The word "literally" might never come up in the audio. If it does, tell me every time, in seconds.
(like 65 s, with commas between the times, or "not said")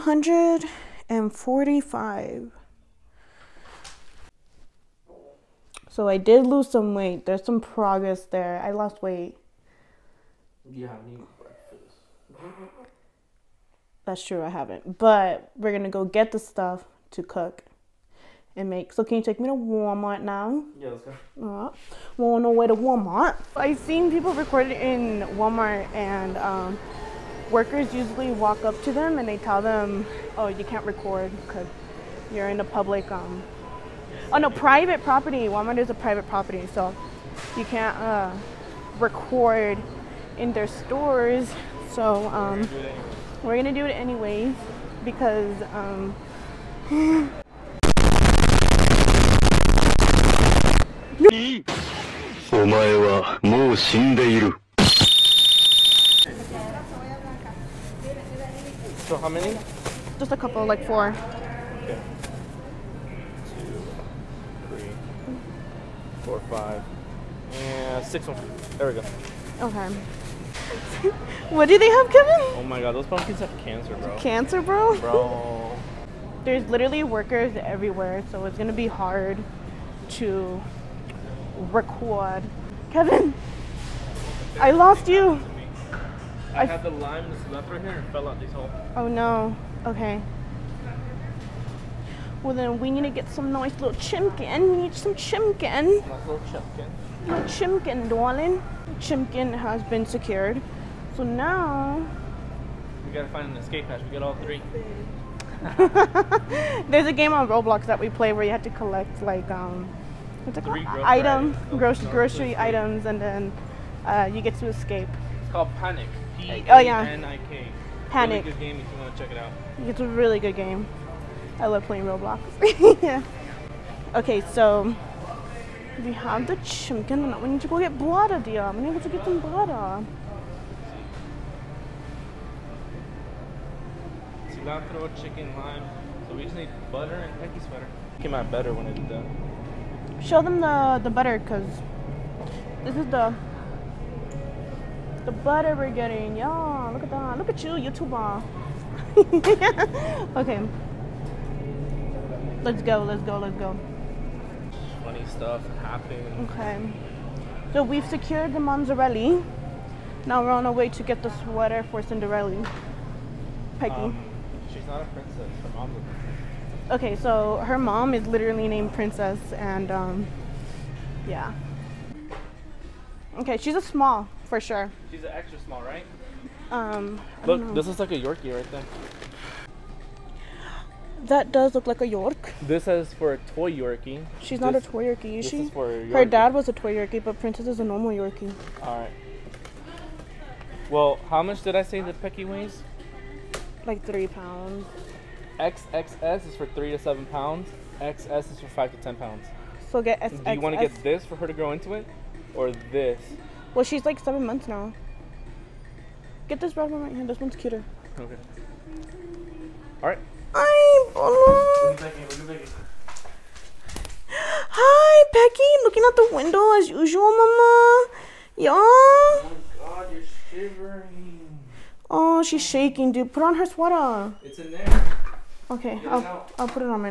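76 s, 168 s.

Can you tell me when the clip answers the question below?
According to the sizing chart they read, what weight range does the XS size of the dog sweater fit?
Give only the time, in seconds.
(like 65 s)
198 s.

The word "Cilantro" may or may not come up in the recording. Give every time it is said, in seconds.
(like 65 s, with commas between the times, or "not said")
134 s.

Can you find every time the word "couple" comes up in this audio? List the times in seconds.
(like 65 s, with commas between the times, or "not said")
60 s.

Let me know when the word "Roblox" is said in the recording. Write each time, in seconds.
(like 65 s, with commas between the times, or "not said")
107 s, 122 s.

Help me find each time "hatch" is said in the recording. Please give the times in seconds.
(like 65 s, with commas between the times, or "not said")
103 s.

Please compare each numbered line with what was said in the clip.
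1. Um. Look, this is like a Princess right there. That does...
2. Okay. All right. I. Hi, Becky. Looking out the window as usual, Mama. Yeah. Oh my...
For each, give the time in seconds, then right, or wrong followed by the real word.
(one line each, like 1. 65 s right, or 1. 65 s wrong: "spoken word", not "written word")
1. 176 s wrong: "Yorkie", not "Princess"
2. 208 s right.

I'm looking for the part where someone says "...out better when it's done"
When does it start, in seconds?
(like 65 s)
138 s.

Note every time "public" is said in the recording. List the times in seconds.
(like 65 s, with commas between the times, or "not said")
32 s.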